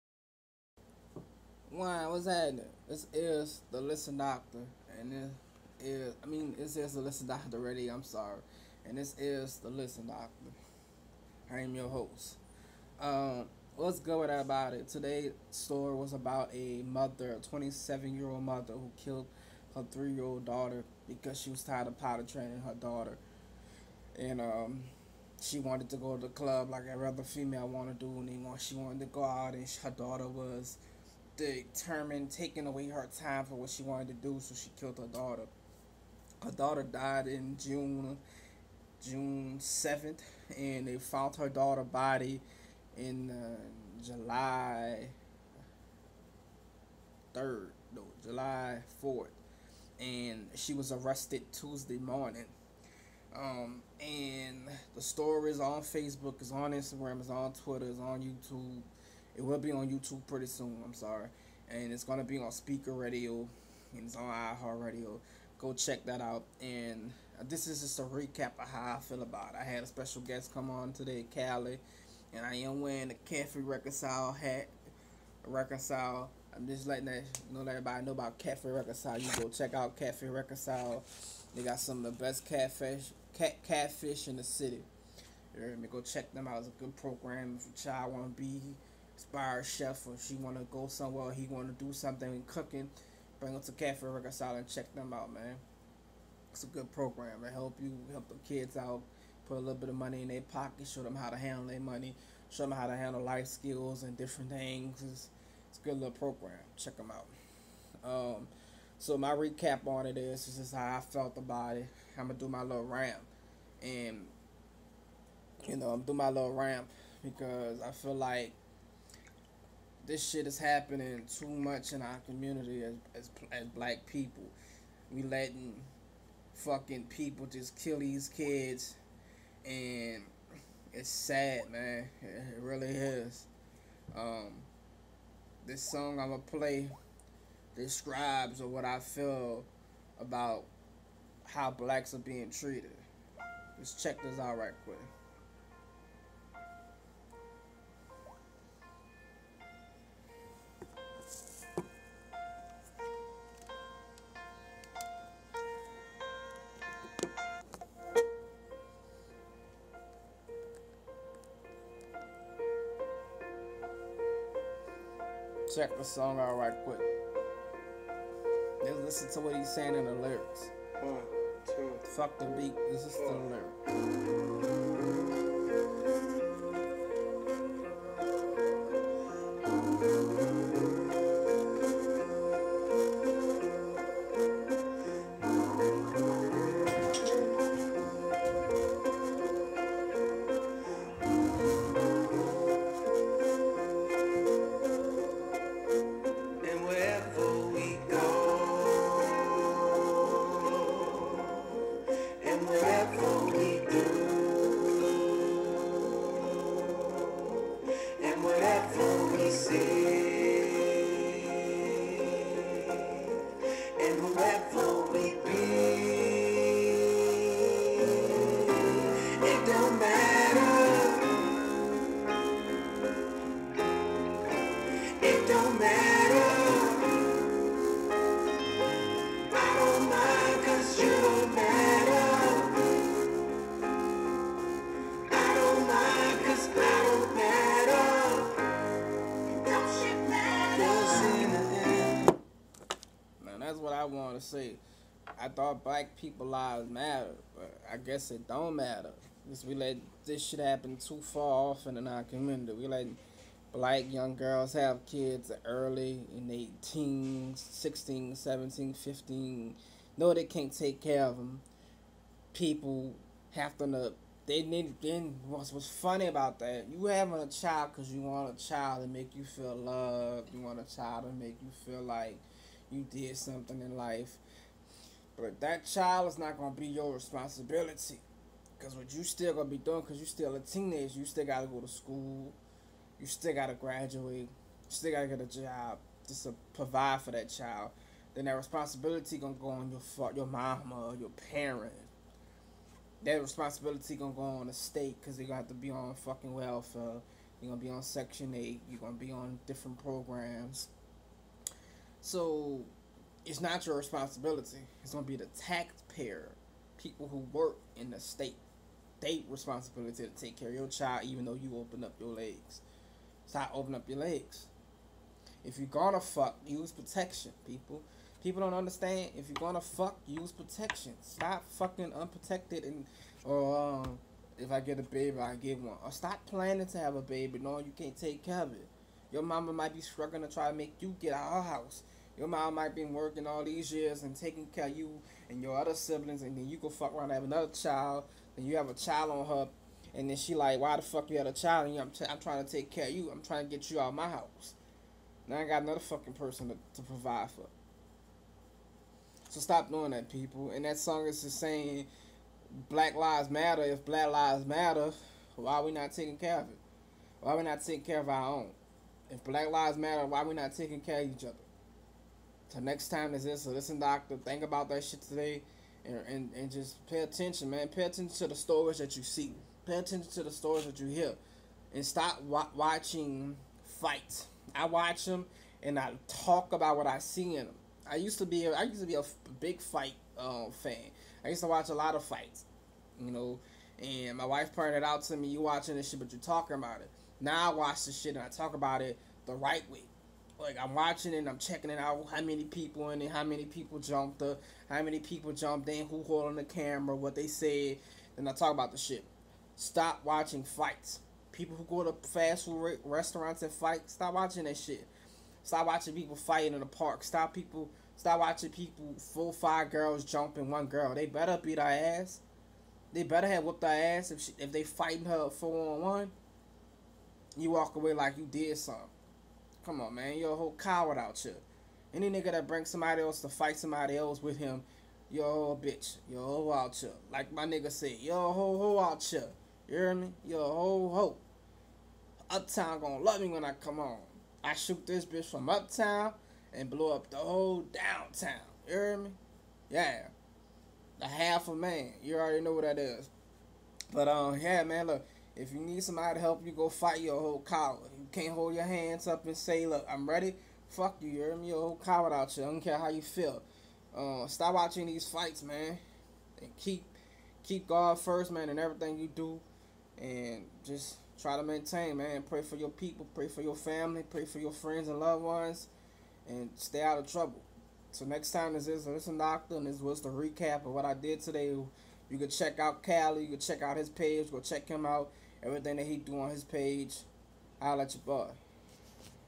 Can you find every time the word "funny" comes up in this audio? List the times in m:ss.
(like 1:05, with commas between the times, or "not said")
4:25.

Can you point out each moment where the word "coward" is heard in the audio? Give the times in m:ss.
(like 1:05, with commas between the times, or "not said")
7:00, 7:27, 7:32.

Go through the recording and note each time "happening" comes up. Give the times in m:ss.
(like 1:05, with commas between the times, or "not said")
0:02, 2:00.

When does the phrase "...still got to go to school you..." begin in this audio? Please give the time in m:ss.
4:41.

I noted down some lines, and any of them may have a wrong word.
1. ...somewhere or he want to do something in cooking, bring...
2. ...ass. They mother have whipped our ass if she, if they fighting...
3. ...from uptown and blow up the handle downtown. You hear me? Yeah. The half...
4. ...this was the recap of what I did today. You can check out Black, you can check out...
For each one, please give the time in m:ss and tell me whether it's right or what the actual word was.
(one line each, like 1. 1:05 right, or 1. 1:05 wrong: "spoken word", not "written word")
1. 1:30 right
2. 6:51 wrong: "better", not "mother"
3. 7:15 wrong: "whole", not "handle"
4. 7:49 wrong: "Kali", not "Black".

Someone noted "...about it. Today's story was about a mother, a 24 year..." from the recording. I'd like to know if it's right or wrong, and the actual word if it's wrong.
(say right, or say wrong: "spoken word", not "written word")
wrong: "27", not "24".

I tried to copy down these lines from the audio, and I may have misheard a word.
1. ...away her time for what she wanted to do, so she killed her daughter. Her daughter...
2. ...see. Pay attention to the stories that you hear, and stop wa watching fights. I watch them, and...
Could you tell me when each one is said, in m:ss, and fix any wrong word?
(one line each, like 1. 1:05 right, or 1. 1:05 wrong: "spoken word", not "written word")
1. 0:32 right
2. 6:09 right.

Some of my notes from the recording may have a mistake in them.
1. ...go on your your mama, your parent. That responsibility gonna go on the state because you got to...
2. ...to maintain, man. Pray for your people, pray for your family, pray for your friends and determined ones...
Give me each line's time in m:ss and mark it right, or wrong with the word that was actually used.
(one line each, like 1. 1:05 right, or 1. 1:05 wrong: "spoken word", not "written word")
1. 4:49 right
2. 7:41 wrong: "loved", not "determined".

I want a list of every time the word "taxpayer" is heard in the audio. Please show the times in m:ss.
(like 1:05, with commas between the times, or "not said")
5:05.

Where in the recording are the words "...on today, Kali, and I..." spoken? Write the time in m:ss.
1:10.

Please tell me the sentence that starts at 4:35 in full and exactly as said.
But that child is not going to be your responsibility.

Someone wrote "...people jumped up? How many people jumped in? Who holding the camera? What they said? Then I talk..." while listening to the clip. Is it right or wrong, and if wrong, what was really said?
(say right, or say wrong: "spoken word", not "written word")
right.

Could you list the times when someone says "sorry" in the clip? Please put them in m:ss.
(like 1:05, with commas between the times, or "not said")
0:08, 1:00.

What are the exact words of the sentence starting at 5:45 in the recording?
Now I got another fucking person to, to provide for.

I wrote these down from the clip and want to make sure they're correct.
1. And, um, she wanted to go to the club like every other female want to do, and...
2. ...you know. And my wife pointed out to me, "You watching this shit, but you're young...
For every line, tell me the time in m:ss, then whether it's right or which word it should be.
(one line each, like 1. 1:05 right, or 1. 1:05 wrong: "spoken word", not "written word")
1. 0:24 right
2. 6:23 wrong: "talking", not "young".